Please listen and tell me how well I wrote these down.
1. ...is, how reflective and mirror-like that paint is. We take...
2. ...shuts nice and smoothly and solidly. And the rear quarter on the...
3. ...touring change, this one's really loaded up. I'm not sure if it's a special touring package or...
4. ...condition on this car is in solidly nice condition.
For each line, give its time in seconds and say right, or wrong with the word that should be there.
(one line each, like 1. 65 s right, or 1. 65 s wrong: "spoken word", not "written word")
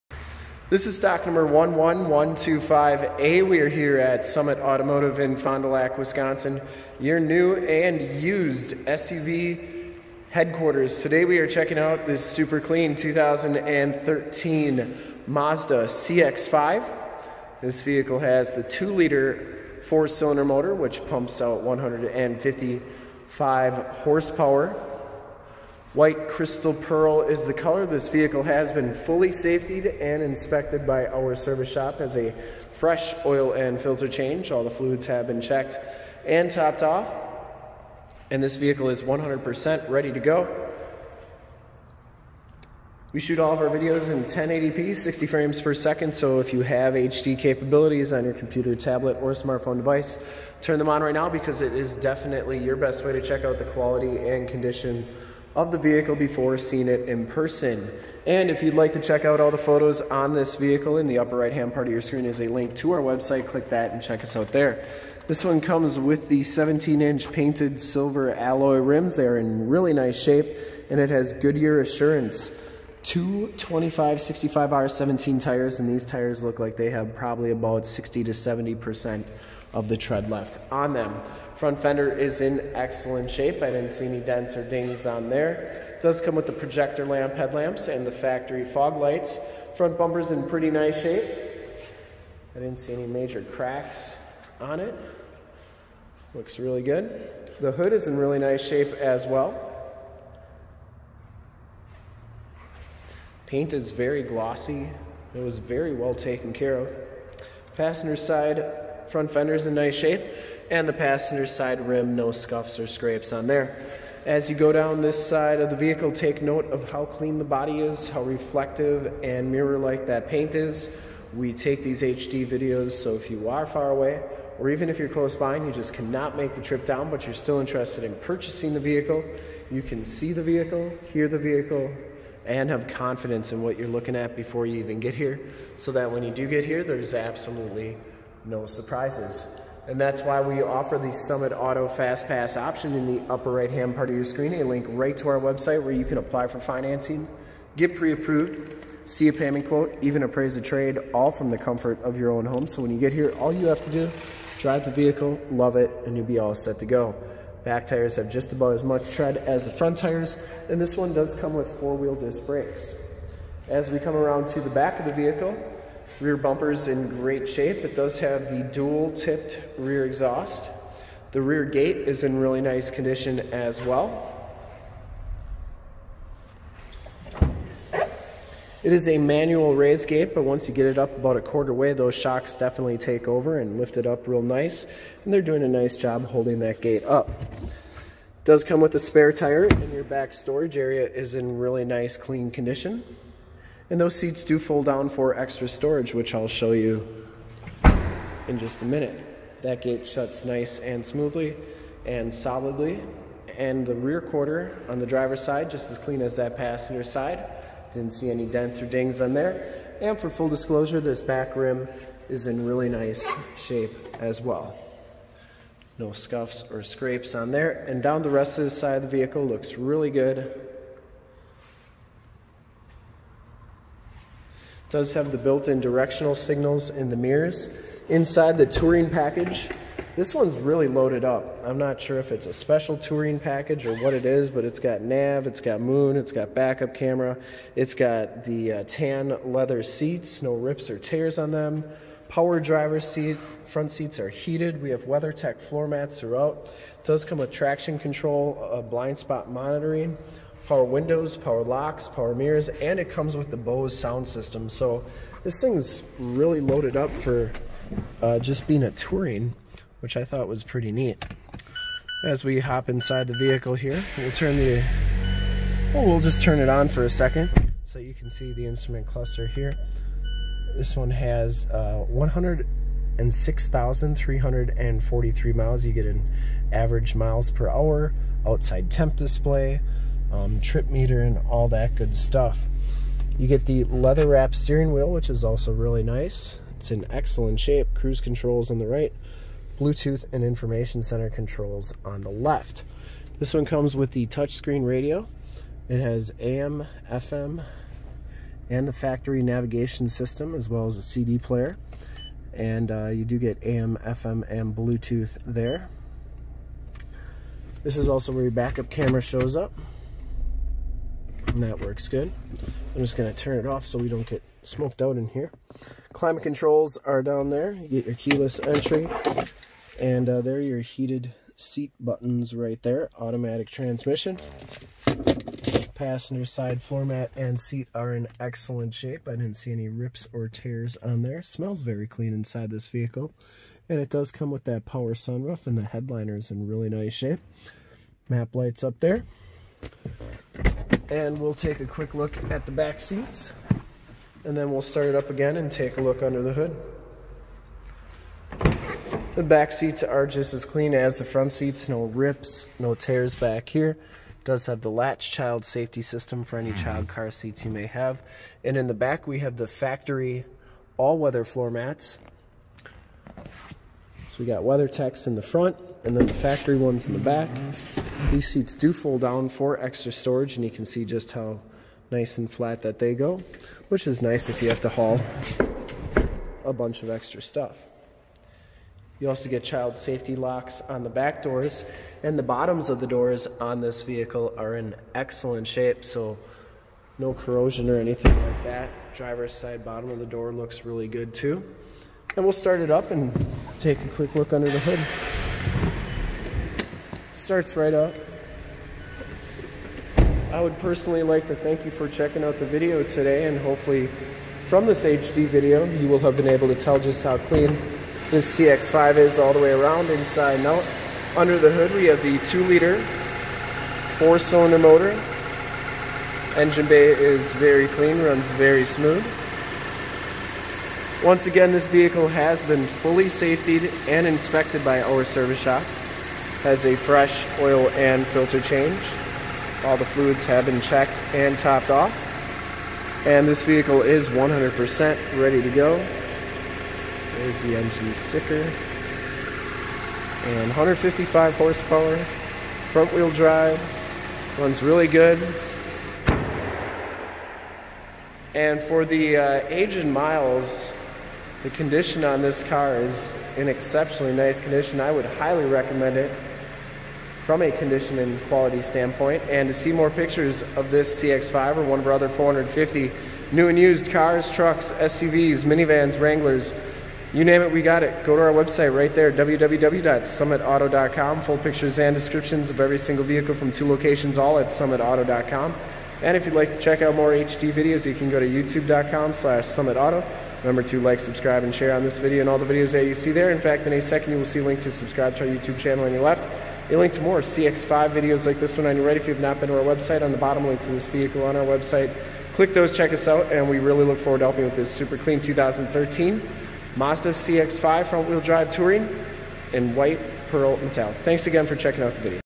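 1. 117 s right
2. 200 s right
3. 228 s wrong: "package", not "change"
4. 451 s wrong: "exceptionally", not "solidly".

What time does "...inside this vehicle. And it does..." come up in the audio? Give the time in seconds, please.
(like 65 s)
332 s.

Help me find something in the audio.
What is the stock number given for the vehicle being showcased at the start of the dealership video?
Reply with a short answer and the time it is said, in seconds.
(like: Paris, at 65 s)
11125A, at 1 s.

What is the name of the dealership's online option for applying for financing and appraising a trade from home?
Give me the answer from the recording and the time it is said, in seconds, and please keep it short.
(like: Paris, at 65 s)
Summit Auto Fast Pass, at 141 s.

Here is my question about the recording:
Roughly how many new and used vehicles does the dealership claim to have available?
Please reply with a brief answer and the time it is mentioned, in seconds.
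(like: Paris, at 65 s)
450, at 462 s.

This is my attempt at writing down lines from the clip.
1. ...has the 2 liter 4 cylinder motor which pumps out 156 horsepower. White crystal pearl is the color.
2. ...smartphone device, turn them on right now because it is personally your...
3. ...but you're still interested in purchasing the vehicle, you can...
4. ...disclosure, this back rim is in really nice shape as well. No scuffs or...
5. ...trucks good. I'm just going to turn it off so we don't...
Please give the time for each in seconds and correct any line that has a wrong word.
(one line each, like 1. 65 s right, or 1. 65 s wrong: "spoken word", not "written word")
1. 18 s wrong: "155", not "156"
2. 49 s wrong: "definitely", not "personally"
3. 127 s right
4. 210 s right
5. 311 s wrong: "works", not "trucks".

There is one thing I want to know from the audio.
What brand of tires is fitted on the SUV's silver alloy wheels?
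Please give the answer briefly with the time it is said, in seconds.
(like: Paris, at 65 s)
Goodyear Assurance, at 71 s.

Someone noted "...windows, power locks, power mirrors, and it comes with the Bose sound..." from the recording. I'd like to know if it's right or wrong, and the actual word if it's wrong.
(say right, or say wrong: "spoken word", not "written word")
right.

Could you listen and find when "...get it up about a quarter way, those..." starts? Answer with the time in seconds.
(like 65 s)
180 s.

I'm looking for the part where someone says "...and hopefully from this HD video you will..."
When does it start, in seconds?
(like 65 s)
403 s.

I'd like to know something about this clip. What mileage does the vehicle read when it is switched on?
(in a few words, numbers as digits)
106,343.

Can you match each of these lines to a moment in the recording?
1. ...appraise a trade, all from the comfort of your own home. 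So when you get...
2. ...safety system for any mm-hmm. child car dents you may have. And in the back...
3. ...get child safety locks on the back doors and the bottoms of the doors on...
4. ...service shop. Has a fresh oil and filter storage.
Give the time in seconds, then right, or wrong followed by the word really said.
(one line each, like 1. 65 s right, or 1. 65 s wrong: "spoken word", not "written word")
1. 150 s right
2. 355 s wrong: "seats", not "dents"
3. 379 s right
4. 425 s wrong: "change", not "storage".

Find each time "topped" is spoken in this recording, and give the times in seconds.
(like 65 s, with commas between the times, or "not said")
36 s, 431 s.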